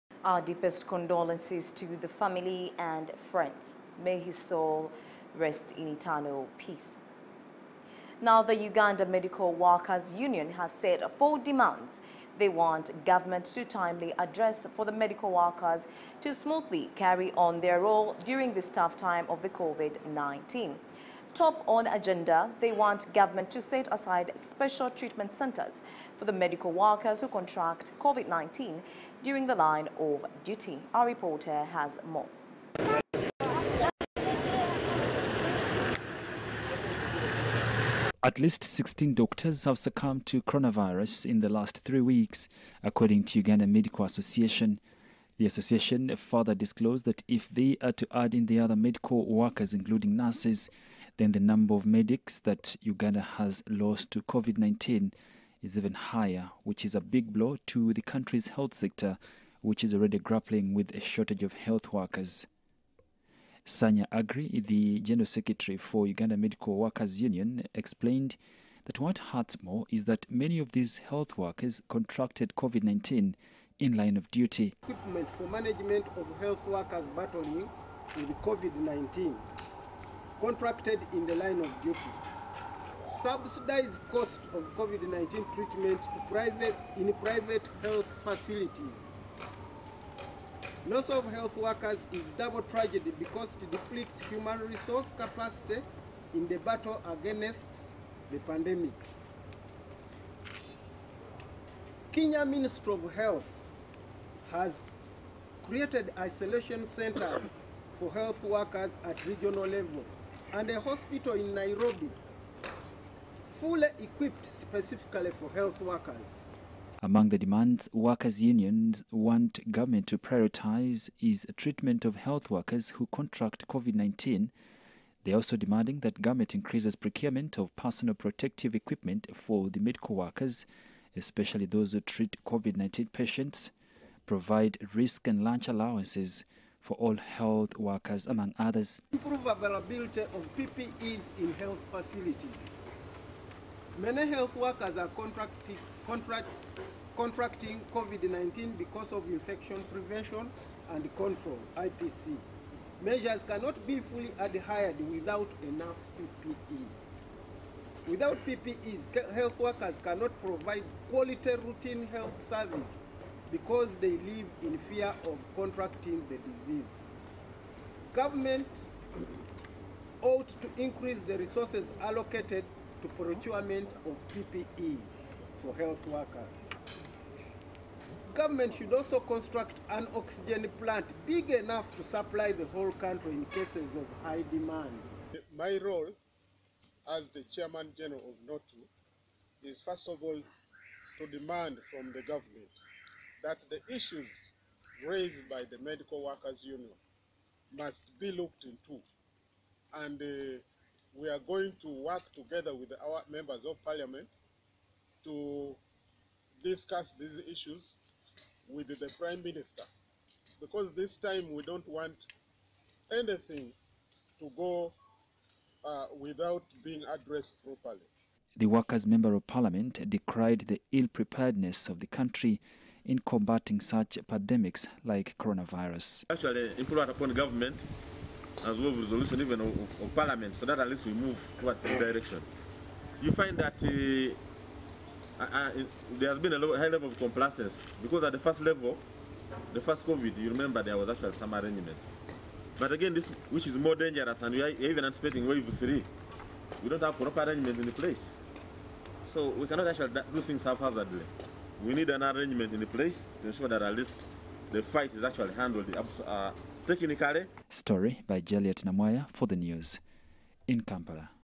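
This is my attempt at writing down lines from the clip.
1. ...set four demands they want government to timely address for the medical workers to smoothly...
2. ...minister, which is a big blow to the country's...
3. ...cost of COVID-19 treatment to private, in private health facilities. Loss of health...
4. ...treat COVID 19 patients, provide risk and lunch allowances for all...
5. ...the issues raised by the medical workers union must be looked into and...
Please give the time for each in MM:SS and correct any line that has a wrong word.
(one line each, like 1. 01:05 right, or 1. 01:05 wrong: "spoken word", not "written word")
1. 00:10 right
2. 00:55 wrong: "higher", not "minister"
3. 01:24 right
4. 02:12 right
5. 03:13 right.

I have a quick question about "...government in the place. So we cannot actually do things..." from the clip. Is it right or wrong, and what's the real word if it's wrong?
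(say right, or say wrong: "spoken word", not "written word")
wrong: "arrangement", not "government".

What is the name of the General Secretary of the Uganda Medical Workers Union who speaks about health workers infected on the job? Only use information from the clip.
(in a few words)
Sanya Agri.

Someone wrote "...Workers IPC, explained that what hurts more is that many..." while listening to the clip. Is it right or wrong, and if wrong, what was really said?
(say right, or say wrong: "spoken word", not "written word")
wrong: "Union", not "IPC".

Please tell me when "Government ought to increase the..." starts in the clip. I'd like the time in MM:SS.
02:48.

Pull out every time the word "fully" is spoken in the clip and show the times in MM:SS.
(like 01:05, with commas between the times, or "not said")
01:53, 02:33.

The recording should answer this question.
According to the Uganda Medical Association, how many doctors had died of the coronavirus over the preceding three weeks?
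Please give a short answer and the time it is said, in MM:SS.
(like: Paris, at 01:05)
16, at 00:38.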